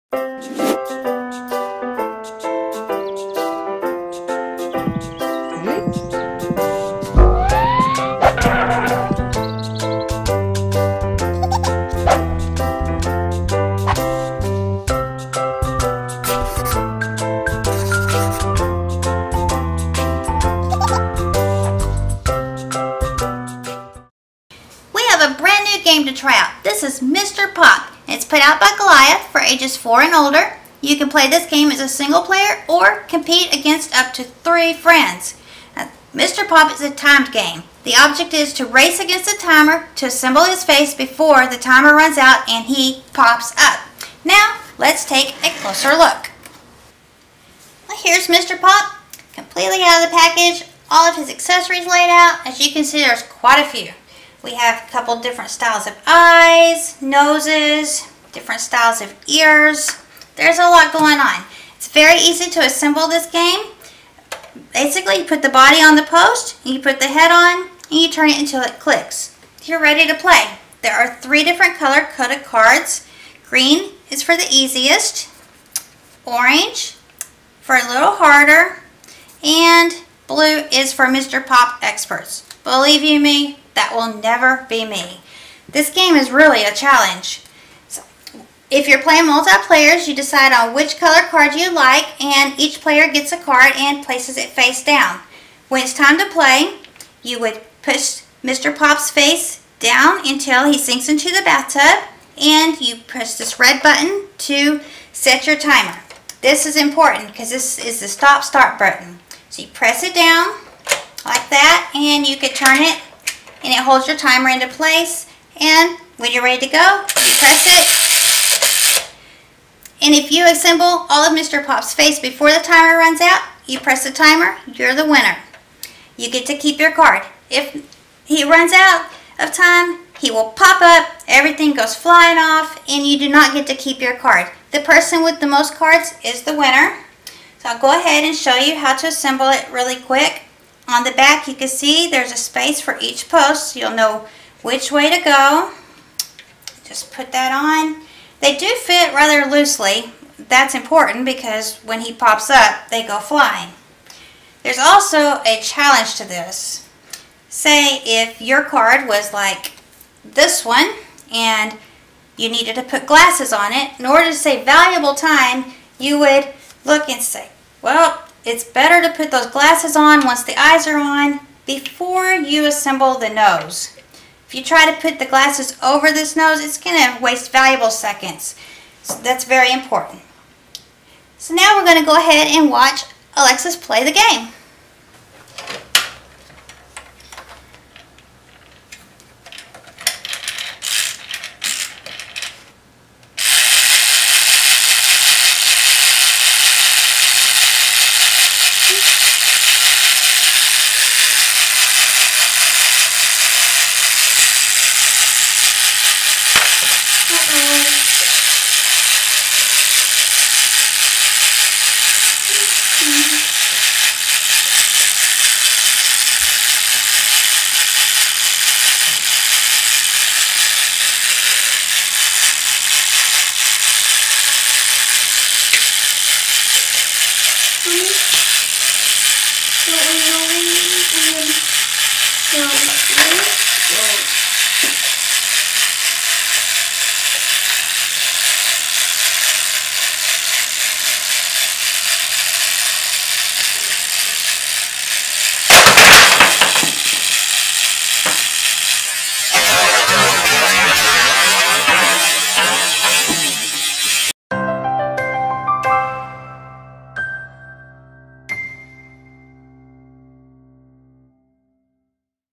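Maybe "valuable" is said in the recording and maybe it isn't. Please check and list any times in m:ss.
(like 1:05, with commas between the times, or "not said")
2:44, 2:57.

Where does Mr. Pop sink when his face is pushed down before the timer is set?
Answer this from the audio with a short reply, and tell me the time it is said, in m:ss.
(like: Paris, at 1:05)
Bathtub, at 1:41.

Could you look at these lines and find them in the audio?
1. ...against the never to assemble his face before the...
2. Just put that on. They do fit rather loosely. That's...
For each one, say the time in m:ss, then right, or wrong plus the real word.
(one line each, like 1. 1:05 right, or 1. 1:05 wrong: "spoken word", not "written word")
1. 0:38 wrong: "timer", not "never"
2. 2:26 right.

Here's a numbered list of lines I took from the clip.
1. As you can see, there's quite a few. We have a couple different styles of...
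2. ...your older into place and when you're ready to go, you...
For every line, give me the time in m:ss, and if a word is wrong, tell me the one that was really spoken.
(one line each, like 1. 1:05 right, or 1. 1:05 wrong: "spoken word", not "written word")
1. 0:52 right
2. 1:54 wrong: "timer", not "older".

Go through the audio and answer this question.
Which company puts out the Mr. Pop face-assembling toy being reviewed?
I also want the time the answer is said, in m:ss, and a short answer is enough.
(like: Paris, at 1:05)
Goliath, at 0:28.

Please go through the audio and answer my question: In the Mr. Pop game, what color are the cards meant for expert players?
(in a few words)
Blue.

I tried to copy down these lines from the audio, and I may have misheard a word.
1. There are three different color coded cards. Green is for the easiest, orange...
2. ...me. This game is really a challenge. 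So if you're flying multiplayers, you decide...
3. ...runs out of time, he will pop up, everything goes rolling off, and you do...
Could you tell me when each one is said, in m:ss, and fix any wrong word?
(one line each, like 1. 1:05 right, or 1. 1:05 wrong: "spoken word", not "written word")
1. 1:10 right
2. 1:24 wrong: "playing", not "flying"
3. 2:08 wrong: "flying", not "rolling".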